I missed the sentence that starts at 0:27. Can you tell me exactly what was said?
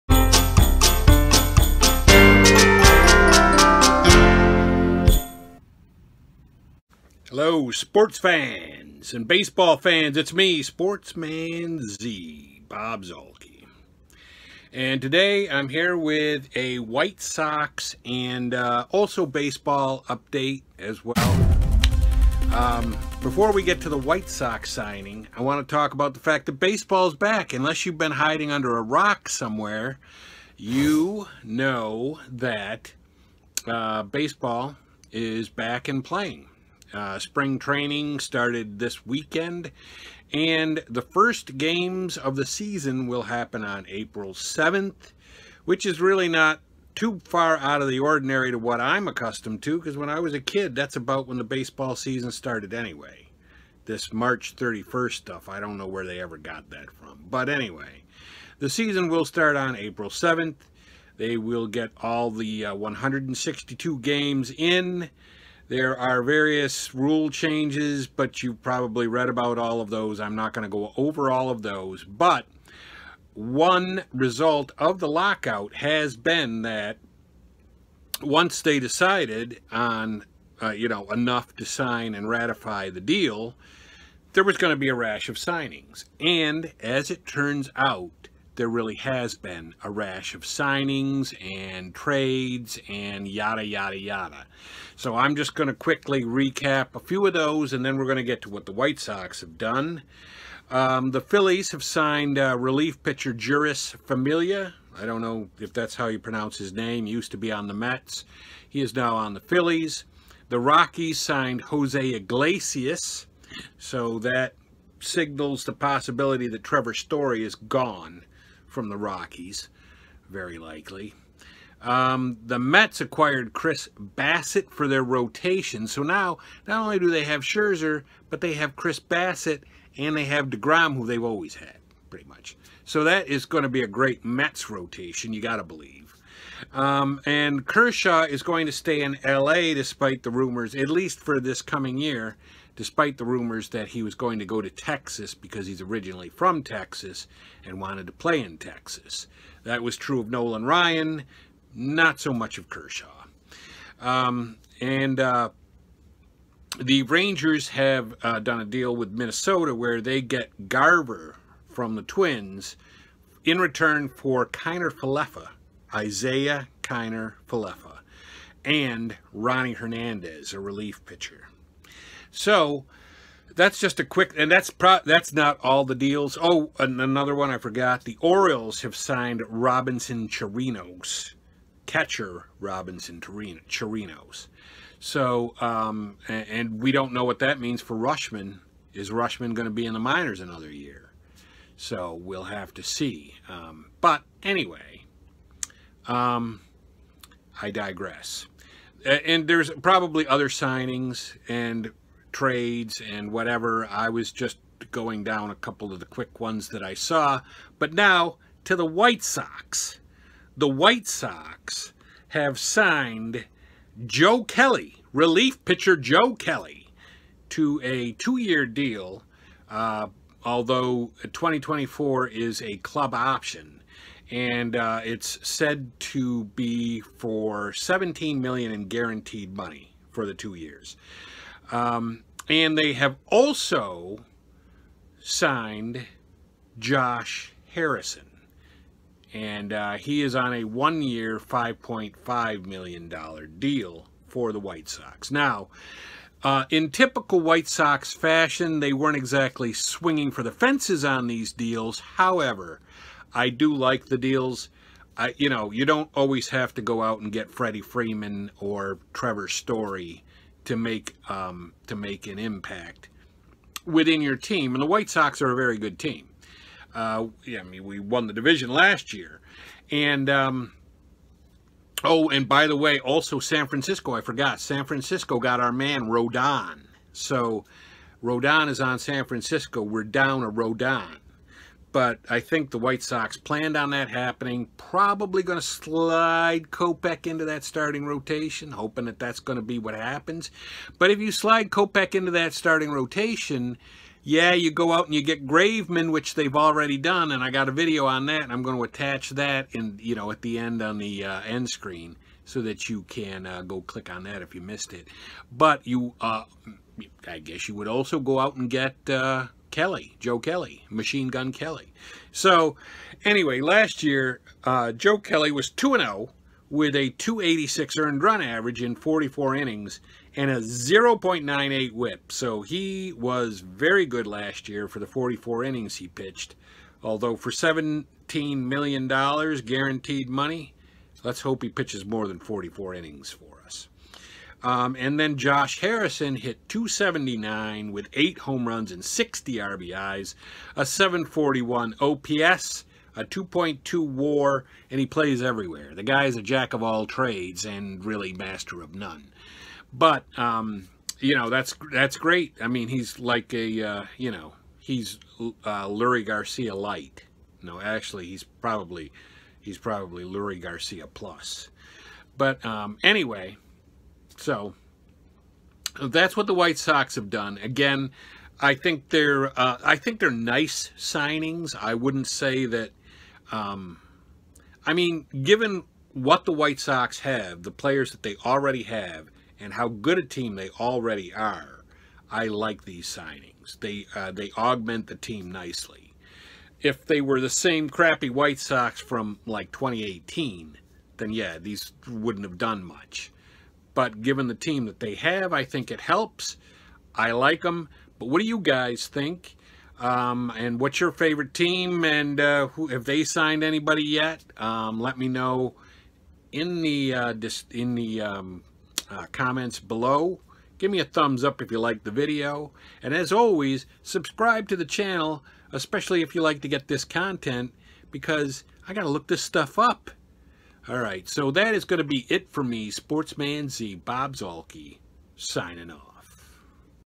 Unless you've been hiding under a rock somewhere, you know that uh, baseball is back and playing.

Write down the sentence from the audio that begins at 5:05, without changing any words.
But you, uh, I guess you would also go out and get uh, Kelly, Joe Kelly, Machine Gun Kelly.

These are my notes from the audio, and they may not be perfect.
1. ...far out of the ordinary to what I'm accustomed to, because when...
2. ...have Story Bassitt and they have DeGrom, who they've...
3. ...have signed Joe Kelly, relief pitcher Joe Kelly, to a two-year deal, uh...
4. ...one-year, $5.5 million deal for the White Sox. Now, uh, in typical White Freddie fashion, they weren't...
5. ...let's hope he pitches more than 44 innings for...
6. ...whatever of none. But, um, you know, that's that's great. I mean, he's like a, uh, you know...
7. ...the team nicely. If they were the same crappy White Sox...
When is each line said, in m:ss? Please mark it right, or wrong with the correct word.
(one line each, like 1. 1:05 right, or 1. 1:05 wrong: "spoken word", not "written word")
1. 0:47 right
2. 2:08 wrong: "Chris", not "Story"
3. 3:32 right
4. 4:00 wrong: "Sox", not "Freddie"
5. 5:31 right
6. 5:48 wrong: "master", not "whatever"
7. 6:25 right.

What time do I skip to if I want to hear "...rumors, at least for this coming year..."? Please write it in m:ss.
2:20.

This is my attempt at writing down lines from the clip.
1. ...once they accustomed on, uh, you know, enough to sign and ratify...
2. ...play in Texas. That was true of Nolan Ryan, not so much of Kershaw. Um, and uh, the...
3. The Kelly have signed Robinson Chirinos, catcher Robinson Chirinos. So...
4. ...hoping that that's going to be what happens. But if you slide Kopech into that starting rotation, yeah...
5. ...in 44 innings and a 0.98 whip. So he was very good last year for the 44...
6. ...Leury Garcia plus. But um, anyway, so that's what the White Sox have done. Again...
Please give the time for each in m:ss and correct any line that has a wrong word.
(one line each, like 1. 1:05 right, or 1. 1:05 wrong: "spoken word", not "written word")
1. 1:18 wrong: "decided", not "accustomed"
2. 2:28 right
3. 2:58 wrong: "Orioles", not "Kelly"
4. 4:48 right
5. 5:18 right
6. 6:00 right.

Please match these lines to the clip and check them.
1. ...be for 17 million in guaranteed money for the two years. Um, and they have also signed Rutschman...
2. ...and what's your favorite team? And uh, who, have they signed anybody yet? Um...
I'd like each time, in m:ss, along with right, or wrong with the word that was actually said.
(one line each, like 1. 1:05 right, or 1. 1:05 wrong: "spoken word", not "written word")
1. 3:46 wrong: "Josh", not "Rutschman"
2. 6:40 right.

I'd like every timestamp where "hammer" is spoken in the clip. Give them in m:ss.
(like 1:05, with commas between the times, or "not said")
not said.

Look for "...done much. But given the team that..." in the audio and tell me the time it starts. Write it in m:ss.
6:32.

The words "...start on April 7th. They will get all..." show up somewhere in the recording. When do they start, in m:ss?
0:59.